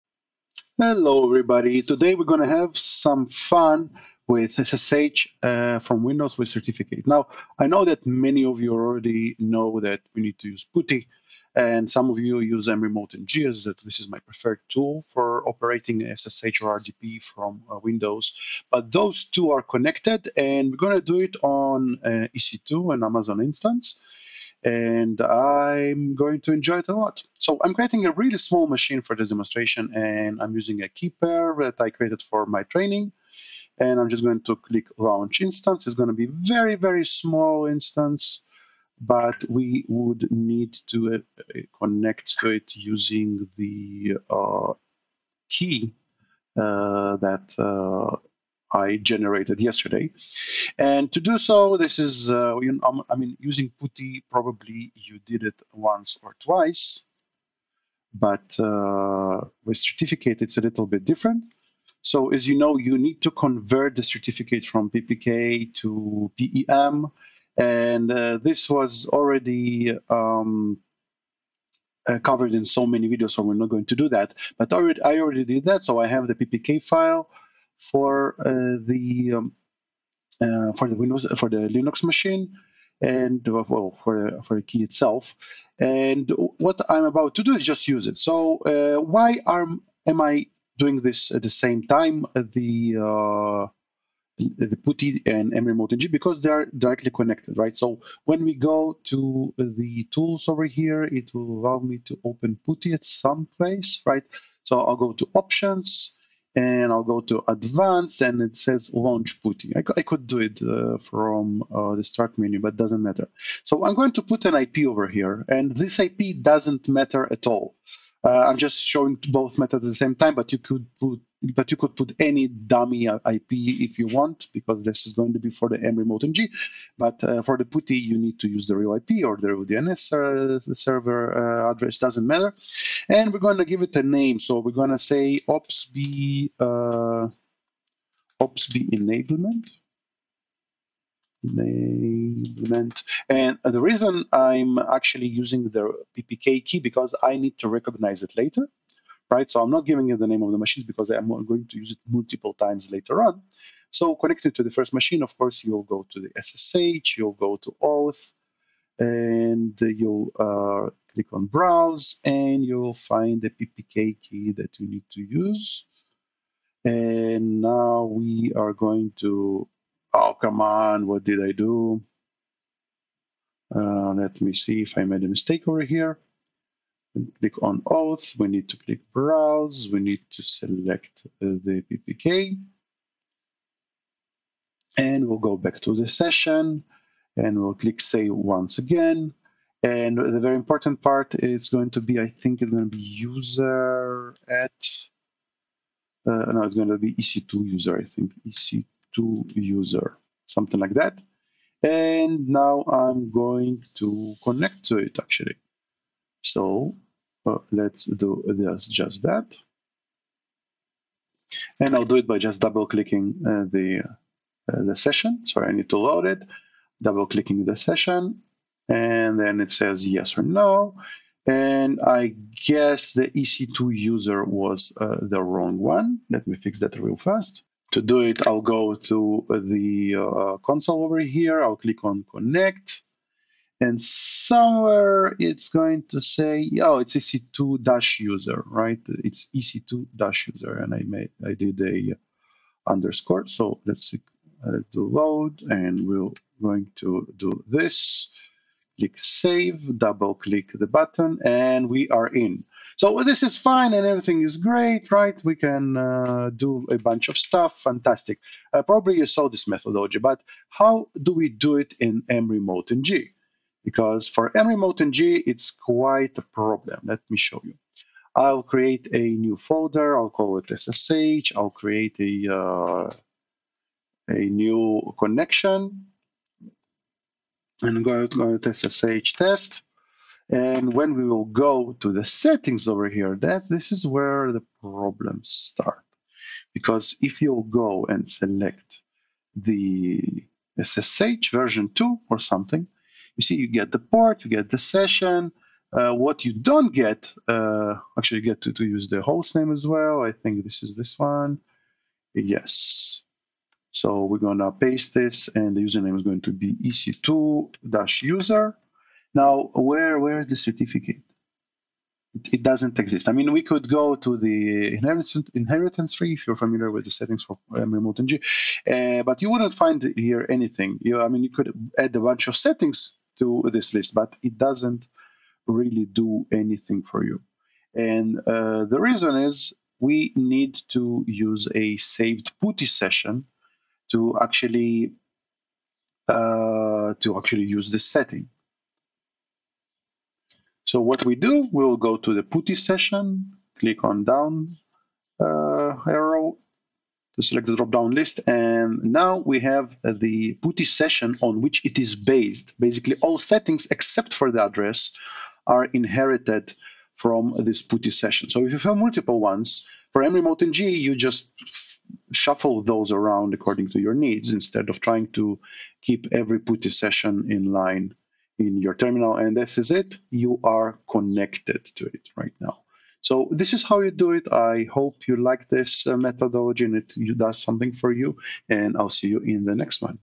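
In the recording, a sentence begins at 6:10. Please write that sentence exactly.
You are connected to it right now.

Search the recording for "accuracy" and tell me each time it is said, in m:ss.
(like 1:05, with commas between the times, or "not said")
not said.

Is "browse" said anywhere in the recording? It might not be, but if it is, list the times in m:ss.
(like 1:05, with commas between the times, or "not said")
2:41, 2:59.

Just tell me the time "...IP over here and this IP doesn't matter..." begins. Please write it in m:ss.
1:54.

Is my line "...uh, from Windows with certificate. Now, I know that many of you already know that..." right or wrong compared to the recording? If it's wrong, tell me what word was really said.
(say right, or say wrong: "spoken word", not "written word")
right.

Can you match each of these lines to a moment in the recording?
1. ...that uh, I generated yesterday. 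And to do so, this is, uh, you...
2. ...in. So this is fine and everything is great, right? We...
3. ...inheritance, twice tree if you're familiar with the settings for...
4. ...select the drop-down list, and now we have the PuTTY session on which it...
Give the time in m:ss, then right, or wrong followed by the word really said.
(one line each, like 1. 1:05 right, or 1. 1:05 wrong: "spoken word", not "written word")
1. 0:47 right
2. 4:12 right
3. 5:14 wrong: "inheritance", not "twice"
4. 5:47 right.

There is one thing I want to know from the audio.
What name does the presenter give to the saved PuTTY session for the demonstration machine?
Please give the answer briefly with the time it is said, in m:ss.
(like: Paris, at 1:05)
OPSB enablement, at 2:18.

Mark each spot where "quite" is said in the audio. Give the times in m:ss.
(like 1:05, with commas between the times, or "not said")
4:25.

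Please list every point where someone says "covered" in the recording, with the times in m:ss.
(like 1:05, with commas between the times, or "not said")
1:12.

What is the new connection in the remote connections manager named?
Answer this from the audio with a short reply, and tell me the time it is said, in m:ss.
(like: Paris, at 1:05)
SSH test, at 4:38.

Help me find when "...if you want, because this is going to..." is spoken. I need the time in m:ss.
2:03.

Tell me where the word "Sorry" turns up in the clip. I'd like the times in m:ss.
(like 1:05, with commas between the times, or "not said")
3:35.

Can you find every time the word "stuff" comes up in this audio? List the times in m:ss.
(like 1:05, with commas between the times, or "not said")
4:17.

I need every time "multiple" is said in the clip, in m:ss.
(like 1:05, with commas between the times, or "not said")
2:32, 5:58.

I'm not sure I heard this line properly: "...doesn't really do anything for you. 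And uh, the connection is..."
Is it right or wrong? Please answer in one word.
wrong.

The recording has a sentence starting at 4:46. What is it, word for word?
Because if you go and select the SSH version 2 or something, you see you get the port, you get the session.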